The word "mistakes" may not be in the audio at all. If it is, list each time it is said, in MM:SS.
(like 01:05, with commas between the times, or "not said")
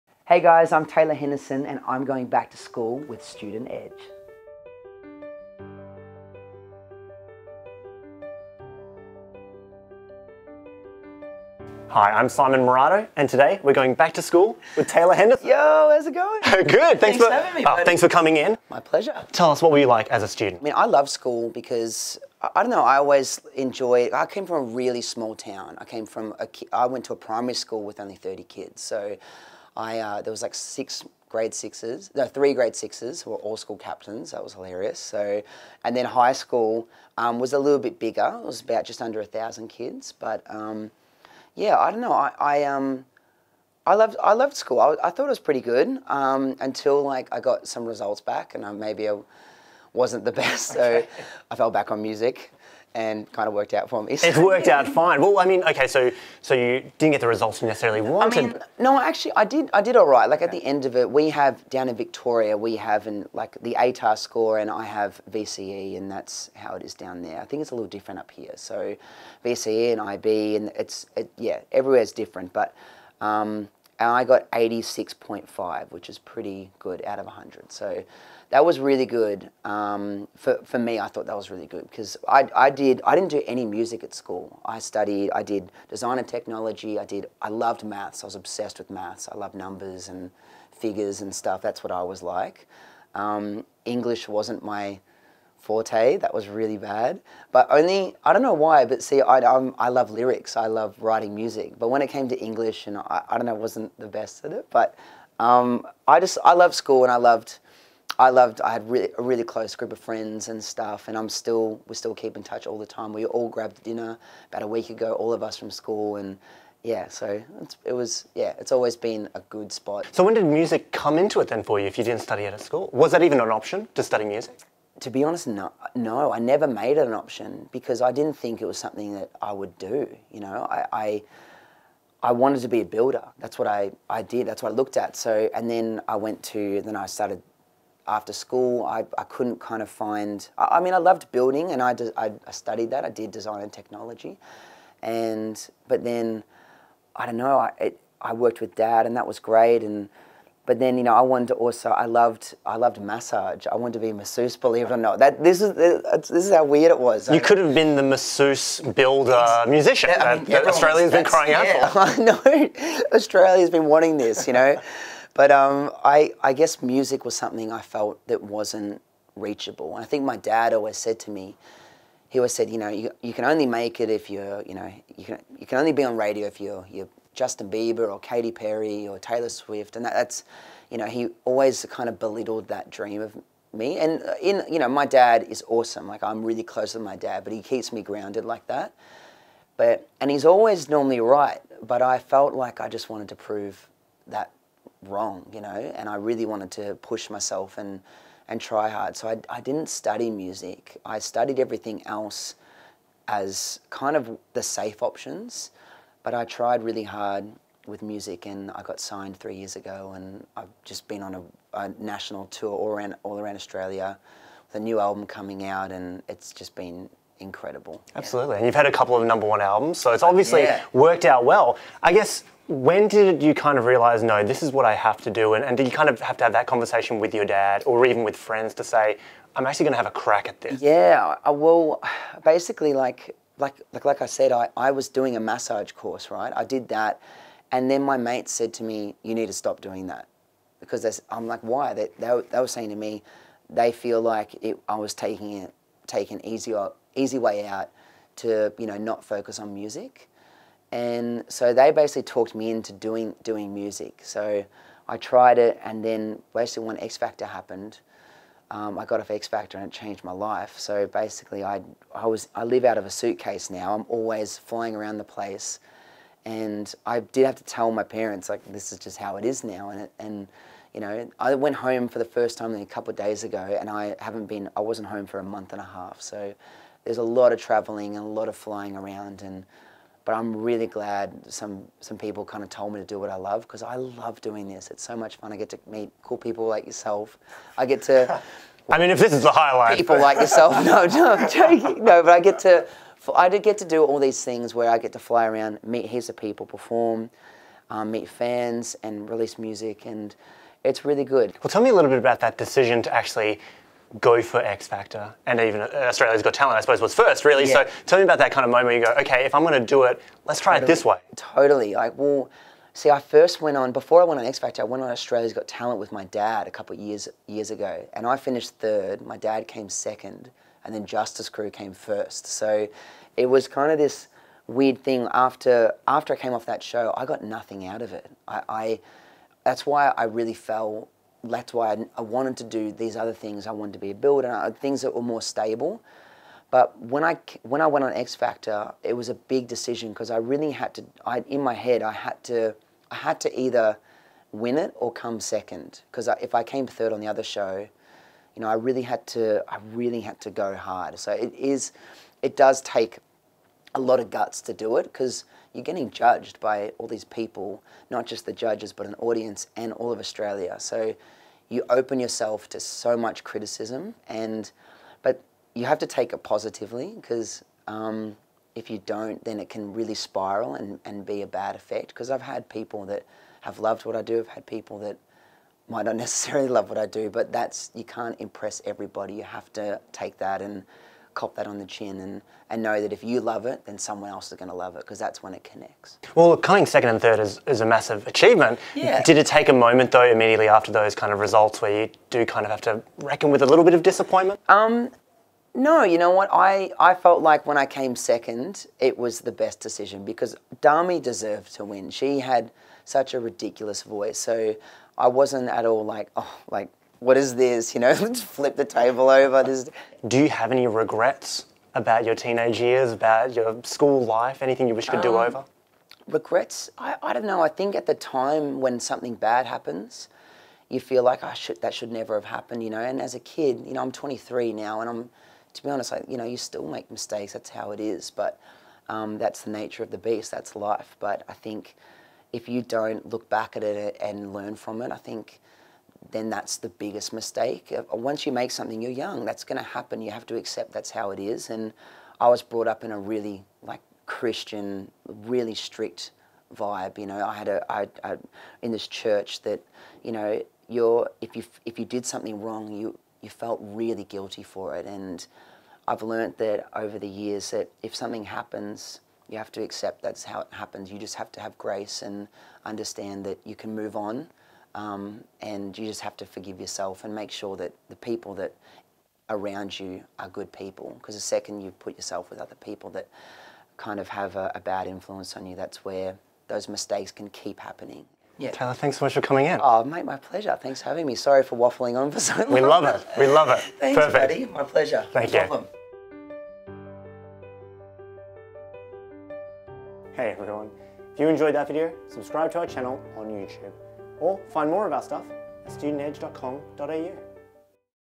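07:07, 07:17, 07:56.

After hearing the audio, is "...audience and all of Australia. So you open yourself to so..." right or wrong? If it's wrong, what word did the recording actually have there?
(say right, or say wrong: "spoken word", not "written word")
right.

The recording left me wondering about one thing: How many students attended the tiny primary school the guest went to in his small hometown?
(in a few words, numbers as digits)
30.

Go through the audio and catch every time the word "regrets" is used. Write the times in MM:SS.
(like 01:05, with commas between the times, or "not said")
06:50, 06:56.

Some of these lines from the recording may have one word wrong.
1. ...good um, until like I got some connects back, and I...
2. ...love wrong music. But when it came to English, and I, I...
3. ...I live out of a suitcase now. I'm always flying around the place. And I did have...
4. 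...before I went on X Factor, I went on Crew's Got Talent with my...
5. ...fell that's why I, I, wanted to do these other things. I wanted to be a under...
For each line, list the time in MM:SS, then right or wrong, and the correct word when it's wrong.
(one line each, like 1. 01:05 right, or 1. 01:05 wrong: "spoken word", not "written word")
1. 00:45 wrong: "results", not "connects"
2. 01:40 wrong: "writing", not "wrong"
3. 04:22 right
4. 05:13 wrong: "Australia", not "Crew"
5. 05:30 wrong: "builder", not "under".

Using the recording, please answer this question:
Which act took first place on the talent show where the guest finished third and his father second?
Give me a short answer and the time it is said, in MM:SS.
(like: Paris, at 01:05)
Justice Crew, at 05:21.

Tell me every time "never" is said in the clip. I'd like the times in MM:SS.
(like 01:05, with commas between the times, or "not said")
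02:06, 07:02.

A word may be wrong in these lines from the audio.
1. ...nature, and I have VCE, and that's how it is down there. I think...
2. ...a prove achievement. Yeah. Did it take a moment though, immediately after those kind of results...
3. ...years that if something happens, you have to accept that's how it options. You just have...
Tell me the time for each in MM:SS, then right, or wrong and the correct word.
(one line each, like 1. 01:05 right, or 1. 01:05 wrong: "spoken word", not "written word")
1. 01:04 wrong: "score", not "nature"
2. 06:27 wrong: "massive", not "prove"
3. 07:37 wrong: "happens", not "options".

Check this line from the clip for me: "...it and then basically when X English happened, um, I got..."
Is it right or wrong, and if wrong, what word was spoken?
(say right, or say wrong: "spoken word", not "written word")
wrong: "Factor", not "English".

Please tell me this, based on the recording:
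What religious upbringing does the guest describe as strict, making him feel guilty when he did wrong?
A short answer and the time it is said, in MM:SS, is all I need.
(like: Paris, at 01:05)
Christian, at 07:24.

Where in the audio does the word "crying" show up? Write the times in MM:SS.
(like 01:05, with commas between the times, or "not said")
02:41.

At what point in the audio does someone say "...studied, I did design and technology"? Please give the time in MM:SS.
01:24.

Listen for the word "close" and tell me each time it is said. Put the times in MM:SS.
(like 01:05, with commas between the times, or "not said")
01:49, 03:06.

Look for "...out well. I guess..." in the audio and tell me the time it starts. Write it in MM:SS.
03:41.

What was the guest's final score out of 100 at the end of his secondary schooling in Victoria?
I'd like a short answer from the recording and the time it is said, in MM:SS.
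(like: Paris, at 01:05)
86.5, at 01:14.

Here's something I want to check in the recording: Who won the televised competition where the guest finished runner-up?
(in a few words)
Dami.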